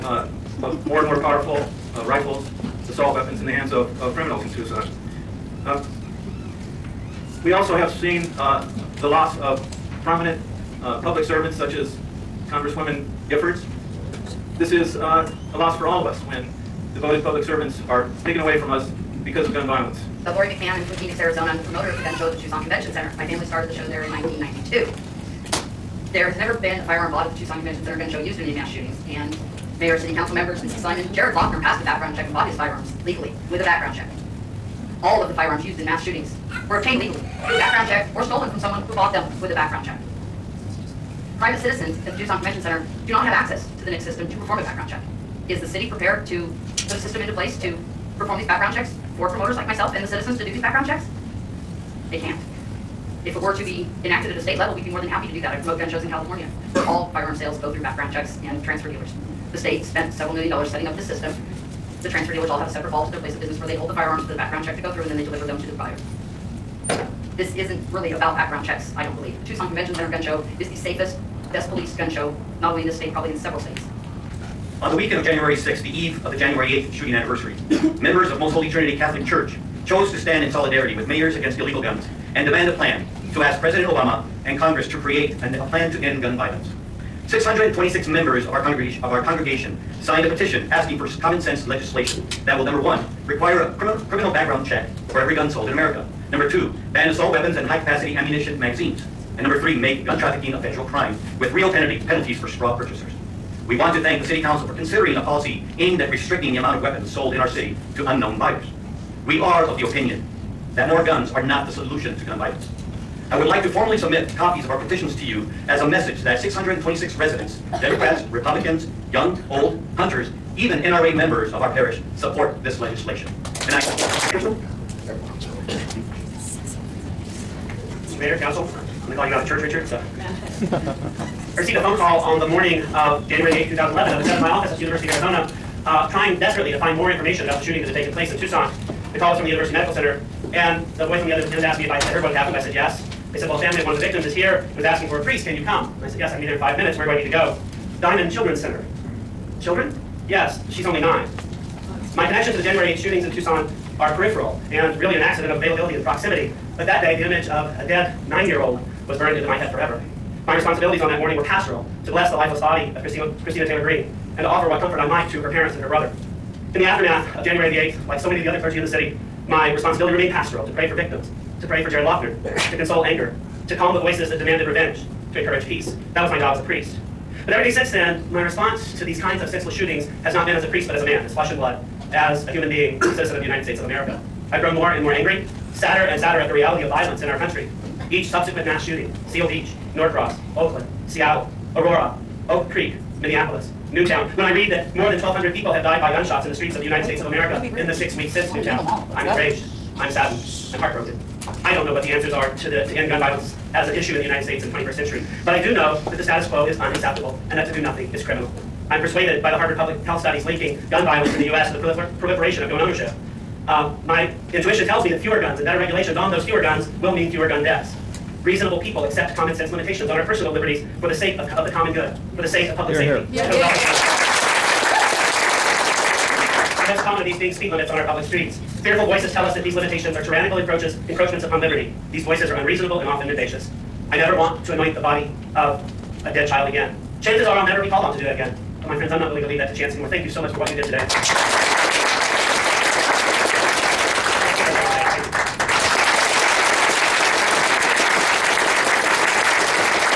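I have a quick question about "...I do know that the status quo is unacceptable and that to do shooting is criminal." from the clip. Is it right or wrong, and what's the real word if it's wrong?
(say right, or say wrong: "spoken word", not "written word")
wrong: "nothing", not "shooting".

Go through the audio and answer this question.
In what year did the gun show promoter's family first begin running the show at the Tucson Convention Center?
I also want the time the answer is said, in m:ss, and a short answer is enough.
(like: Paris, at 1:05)
1992, at 0:24.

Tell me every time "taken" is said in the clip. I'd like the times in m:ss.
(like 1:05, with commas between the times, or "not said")
0:18, 2:17.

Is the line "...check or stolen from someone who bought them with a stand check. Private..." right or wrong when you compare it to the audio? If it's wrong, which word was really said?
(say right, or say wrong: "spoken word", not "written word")
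wrong: "background", not "stand".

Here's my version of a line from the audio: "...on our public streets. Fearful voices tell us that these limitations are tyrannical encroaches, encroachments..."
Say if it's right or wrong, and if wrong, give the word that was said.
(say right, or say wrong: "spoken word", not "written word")
right.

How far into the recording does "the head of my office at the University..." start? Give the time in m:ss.
2:14.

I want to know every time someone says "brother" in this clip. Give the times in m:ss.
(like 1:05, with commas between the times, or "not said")
2:45.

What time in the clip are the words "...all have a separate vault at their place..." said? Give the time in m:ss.
1:02.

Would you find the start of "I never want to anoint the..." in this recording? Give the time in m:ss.
3:54.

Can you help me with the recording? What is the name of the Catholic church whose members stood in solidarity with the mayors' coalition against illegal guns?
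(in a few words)
Most Holy Trinity.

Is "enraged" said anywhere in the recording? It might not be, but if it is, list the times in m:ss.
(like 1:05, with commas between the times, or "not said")
3:19.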